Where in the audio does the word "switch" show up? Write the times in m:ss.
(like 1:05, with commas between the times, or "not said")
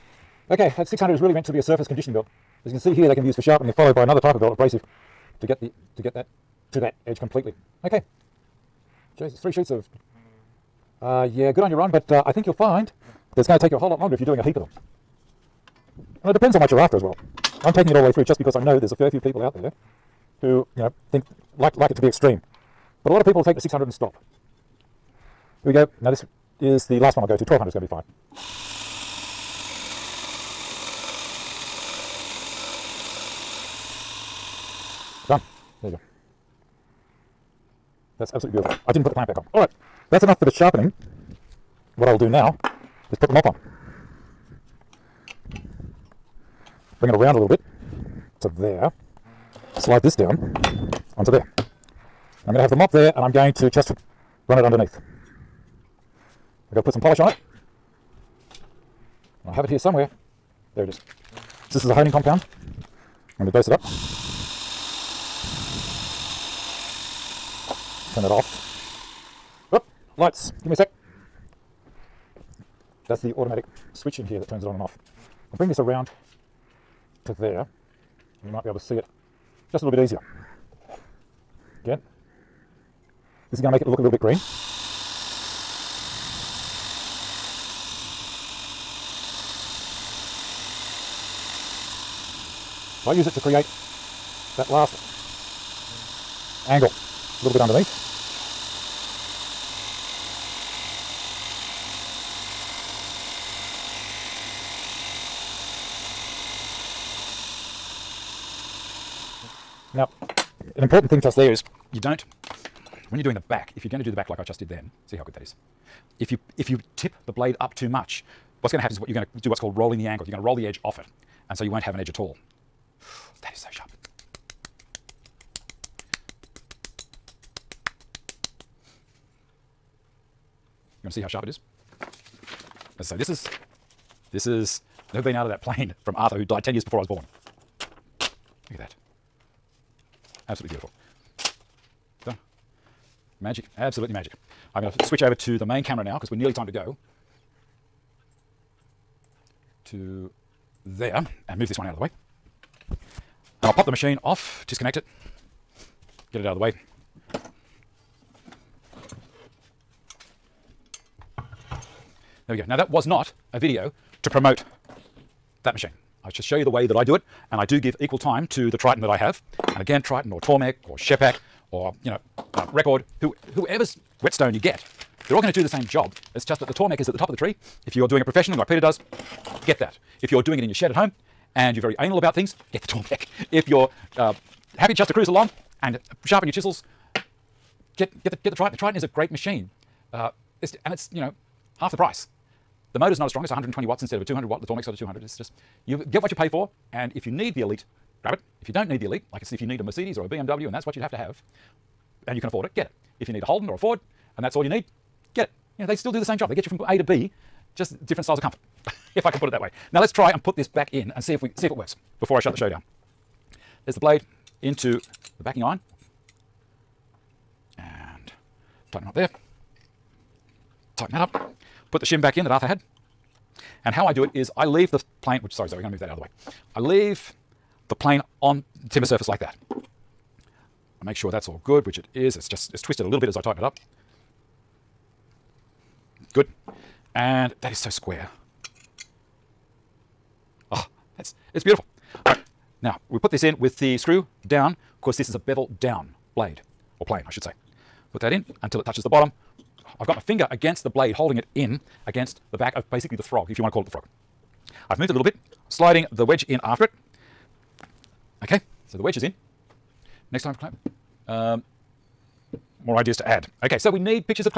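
1:13, 2:25.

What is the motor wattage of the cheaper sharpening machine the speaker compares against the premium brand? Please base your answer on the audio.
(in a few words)
120 watts.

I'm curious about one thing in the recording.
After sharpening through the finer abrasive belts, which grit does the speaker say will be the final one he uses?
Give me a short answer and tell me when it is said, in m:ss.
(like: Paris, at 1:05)
1200, at 0:27.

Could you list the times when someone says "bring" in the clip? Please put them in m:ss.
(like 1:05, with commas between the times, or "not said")
0:47, 1:15.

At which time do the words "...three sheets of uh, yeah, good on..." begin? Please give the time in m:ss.
0:09.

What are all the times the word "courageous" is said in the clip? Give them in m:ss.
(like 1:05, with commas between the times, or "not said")
not said.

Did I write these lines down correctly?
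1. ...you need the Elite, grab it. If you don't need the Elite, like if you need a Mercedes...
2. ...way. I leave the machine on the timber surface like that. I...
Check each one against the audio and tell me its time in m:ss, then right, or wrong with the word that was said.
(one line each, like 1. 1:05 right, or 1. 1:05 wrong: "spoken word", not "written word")
1. 3:17 right
2. 3:46 wrong: "plane", not "machine".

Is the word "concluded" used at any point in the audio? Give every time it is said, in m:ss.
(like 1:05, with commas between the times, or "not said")
not said.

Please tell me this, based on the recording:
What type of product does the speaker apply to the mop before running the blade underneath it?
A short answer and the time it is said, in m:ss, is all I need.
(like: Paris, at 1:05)
Honing compound, at 1:01.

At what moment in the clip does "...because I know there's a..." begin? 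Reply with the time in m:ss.
0:18.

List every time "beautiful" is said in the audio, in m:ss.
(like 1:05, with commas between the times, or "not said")
0:38, 2:20, 4:01.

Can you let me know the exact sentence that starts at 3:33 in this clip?
There's the blade into the backing iron.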